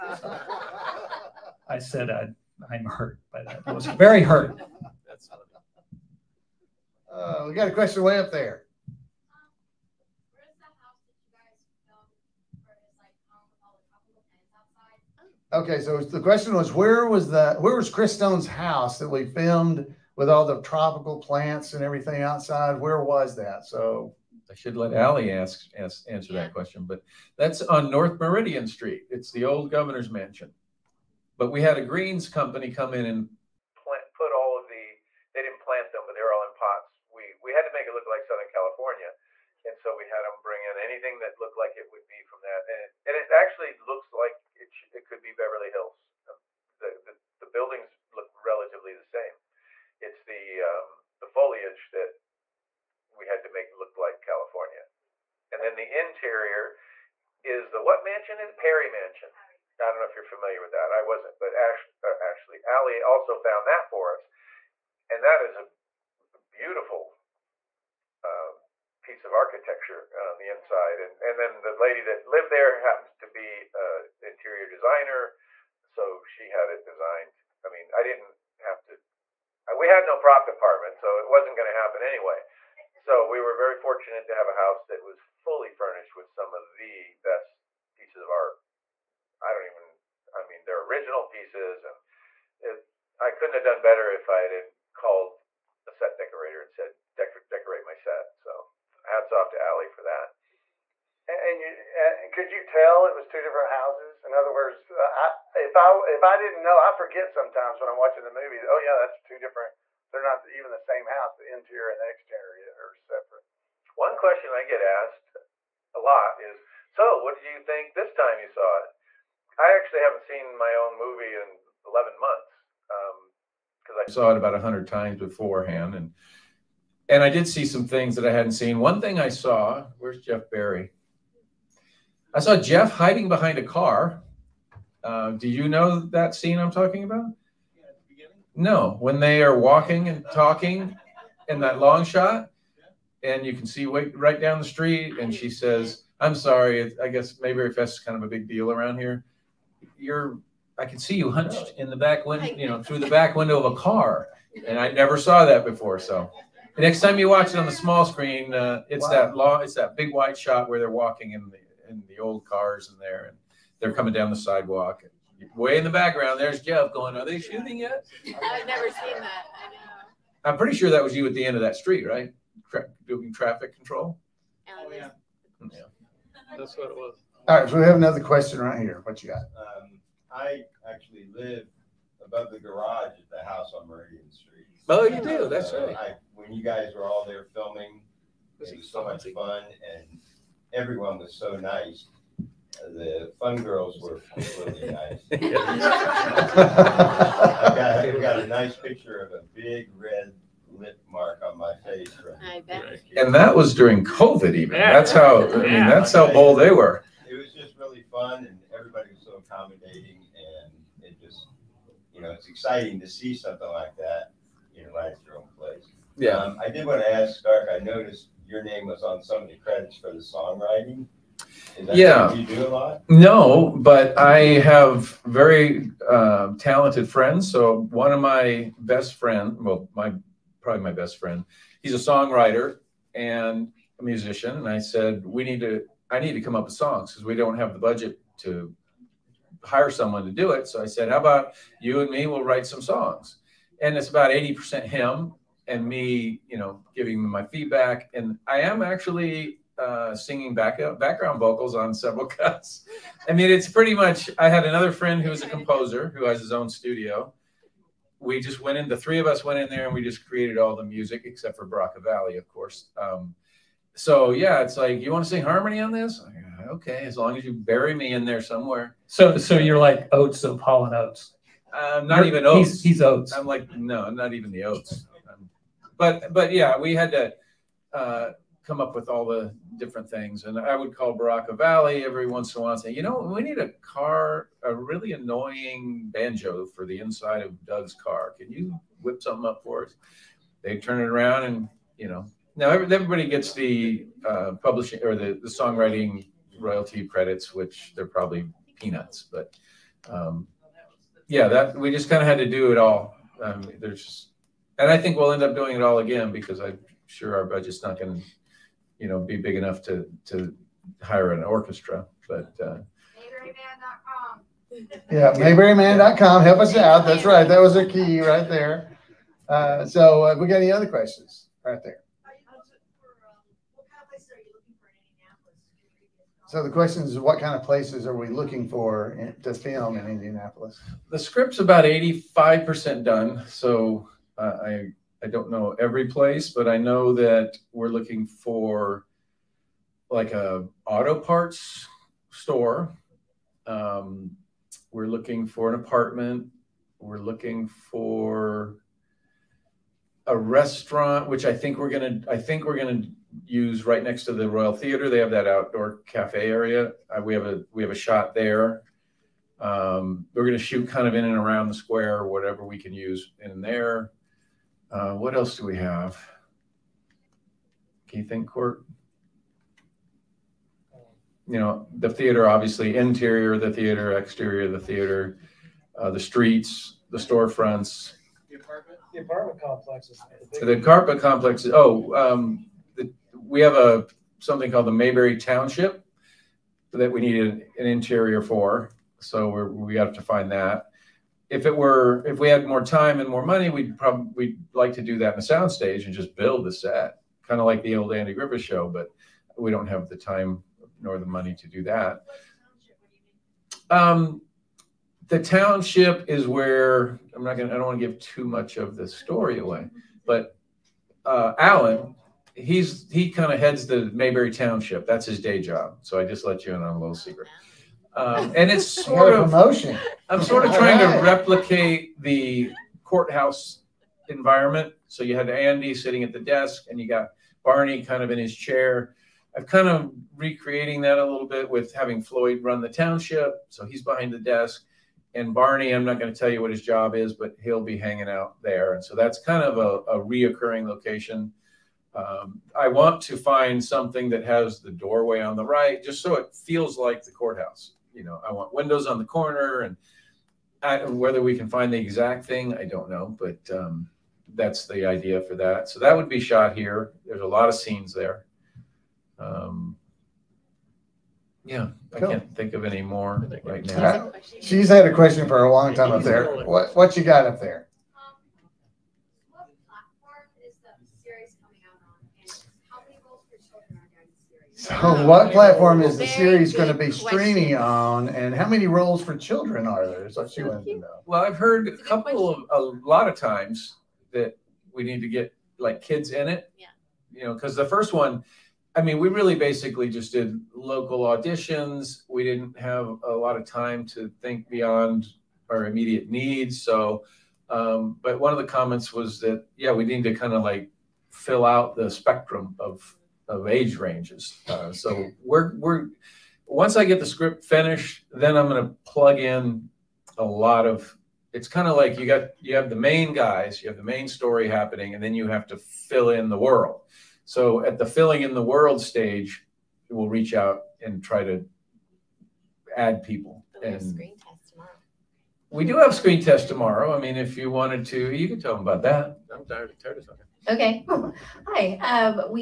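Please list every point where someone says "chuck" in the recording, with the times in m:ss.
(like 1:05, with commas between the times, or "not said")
not said.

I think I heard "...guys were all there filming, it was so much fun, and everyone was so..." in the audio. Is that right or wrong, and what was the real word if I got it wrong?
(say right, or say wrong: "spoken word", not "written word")
right.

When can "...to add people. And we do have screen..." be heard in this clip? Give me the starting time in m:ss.
8:41.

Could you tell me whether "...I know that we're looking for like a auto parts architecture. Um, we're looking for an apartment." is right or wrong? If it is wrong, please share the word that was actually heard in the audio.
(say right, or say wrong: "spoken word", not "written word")
wrong: "store", not "architecture".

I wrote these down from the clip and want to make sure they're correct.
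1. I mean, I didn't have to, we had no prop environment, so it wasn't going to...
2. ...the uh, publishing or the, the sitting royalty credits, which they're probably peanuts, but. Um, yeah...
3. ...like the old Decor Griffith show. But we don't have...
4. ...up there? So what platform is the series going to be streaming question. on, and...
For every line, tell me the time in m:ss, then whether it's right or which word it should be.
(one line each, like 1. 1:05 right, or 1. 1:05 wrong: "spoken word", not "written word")
1. 1:17 wrong: "department", not "environment"
2. 4:53 wrong: "songwriting", not "sitting"
3. 6:37 wrong: "Andy", not "Decor"
4. 7:47 right.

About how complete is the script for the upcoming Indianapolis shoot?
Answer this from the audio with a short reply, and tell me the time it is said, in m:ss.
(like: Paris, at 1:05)
85%, at 5:31.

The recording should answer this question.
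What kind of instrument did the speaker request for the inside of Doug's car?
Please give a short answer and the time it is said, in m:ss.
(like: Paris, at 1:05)
banjo, at 4:46.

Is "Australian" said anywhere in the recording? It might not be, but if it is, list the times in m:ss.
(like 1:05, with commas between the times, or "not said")
not said.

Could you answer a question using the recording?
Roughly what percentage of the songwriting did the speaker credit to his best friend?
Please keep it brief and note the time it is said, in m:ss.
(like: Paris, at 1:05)
80%, at 4:04.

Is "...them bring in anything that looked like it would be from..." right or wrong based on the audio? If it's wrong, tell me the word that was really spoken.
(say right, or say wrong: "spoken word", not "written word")
right.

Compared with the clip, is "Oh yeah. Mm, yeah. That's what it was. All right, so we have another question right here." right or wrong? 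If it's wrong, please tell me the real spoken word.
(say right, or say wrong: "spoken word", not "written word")
right.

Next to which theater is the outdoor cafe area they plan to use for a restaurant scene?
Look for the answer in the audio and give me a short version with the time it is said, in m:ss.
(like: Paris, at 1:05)
Royal Theater, at 5:54.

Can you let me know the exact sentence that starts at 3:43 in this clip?
No, but I have very uh, talented friends.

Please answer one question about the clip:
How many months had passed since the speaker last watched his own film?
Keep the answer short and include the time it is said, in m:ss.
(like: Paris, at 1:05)
11, at 2:01.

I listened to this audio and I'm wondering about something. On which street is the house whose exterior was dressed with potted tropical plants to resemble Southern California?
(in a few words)
North Meridian Street.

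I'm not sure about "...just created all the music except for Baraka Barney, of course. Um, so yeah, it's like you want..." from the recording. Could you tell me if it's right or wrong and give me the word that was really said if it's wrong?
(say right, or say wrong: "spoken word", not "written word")
wrong: "Valley", not "Barney".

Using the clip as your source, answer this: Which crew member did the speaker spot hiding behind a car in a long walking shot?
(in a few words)
Jeff Barry.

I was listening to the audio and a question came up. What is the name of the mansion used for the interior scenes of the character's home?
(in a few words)
Perry Mansion.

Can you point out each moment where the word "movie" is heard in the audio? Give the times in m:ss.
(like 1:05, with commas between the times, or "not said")
1:48, 2:00.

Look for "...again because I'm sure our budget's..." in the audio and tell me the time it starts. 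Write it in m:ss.
5:05.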